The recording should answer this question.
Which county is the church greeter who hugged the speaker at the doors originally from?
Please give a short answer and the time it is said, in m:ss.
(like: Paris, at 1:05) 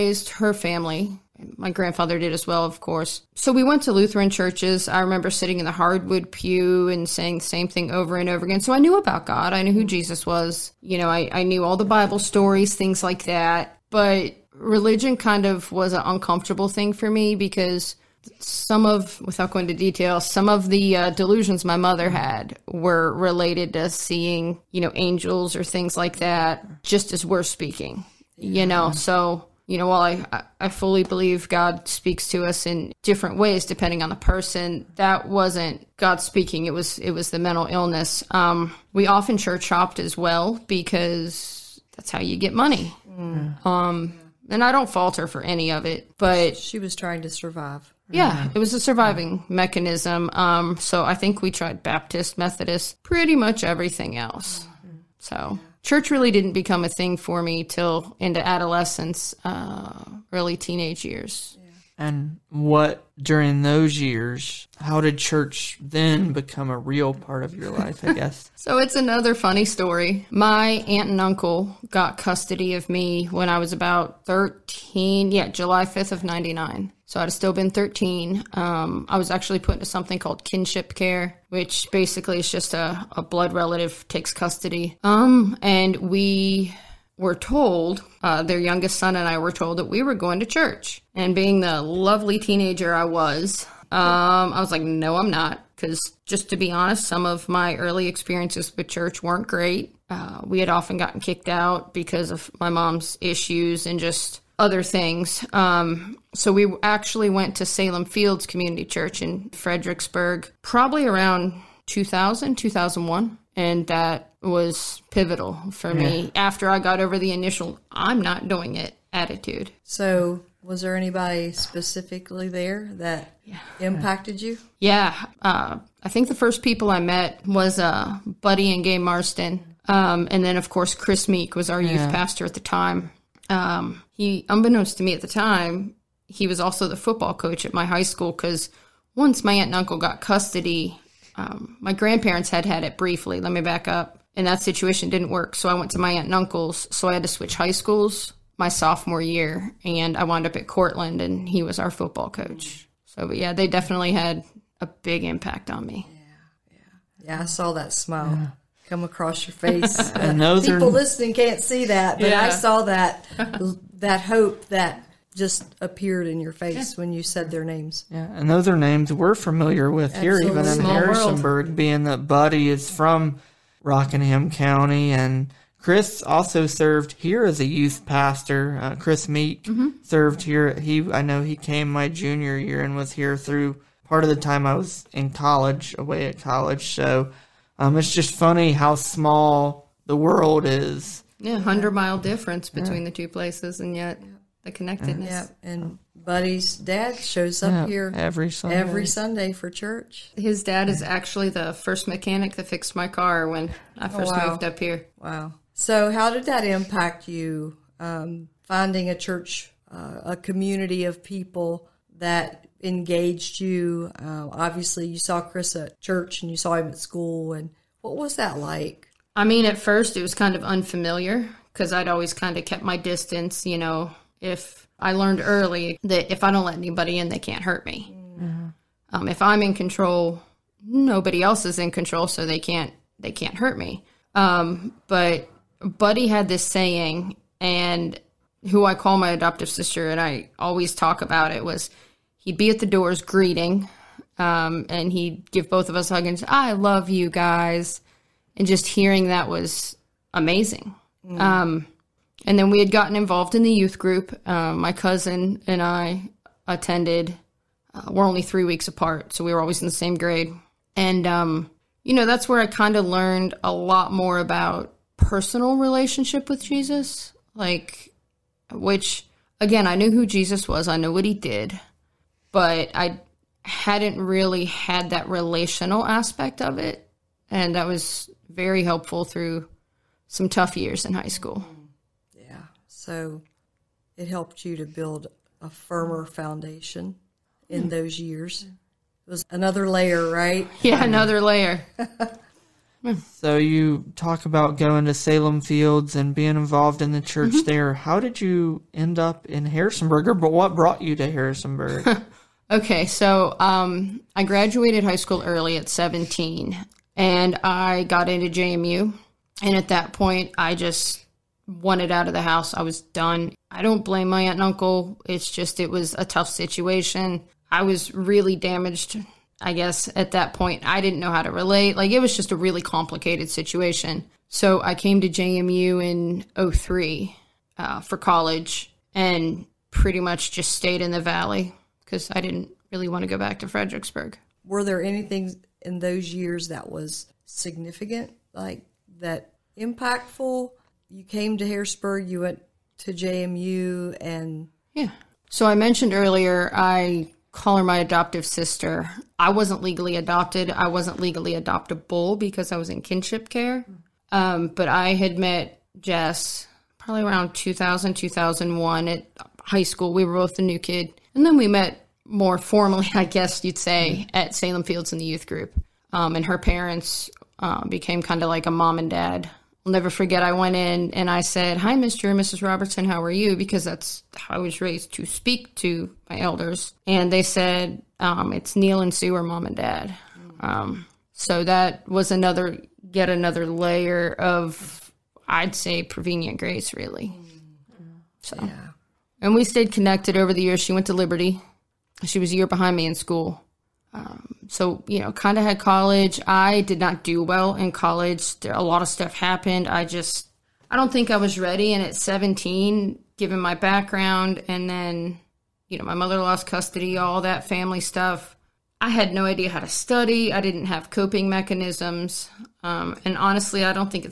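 Rockingham County, at 2:53.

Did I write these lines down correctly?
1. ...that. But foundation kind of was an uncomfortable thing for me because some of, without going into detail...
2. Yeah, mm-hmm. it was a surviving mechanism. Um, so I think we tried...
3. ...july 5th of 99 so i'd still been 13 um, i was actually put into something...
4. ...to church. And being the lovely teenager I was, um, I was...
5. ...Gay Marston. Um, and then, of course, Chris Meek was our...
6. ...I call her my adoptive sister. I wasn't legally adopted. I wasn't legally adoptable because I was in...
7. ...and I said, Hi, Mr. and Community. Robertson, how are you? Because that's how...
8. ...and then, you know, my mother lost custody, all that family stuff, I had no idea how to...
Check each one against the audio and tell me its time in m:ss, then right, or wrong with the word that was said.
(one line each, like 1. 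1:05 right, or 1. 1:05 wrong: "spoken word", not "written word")
1. 0:13 wrong: "religion", not "foundation"
2. 0:48 right
3. 1:15 right
4. 1:30 right
5. 2:08 right
6. 5:46 right
7. 6:11 wrong: "Mrs", not "Community"
8. 6:44 right.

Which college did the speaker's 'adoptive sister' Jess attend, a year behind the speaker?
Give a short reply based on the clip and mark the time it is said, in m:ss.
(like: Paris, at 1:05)
Liberty, at 6:31.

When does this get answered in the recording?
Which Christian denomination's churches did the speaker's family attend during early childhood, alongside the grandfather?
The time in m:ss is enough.
0:03.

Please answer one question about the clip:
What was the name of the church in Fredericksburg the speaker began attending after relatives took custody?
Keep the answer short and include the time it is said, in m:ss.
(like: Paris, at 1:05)
Salem Fields Community Church, at 1:47.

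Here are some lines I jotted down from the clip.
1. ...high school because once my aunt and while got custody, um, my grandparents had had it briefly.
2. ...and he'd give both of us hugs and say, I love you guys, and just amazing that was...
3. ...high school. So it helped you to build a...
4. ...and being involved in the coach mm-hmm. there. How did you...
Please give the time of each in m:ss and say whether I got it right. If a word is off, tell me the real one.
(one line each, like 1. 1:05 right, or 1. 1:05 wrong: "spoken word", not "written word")
1. 2:17 wrong: "uncle", not "while"
2. 4:04 wrong: "hearing", not "amazing"
3. 4:41 right
4. 4:56 wrong: "church", not "coach".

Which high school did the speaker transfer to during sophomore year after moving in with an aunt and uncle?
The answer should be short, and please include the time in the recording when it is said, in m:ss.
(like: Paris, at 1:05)
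Courtland, at 2:30.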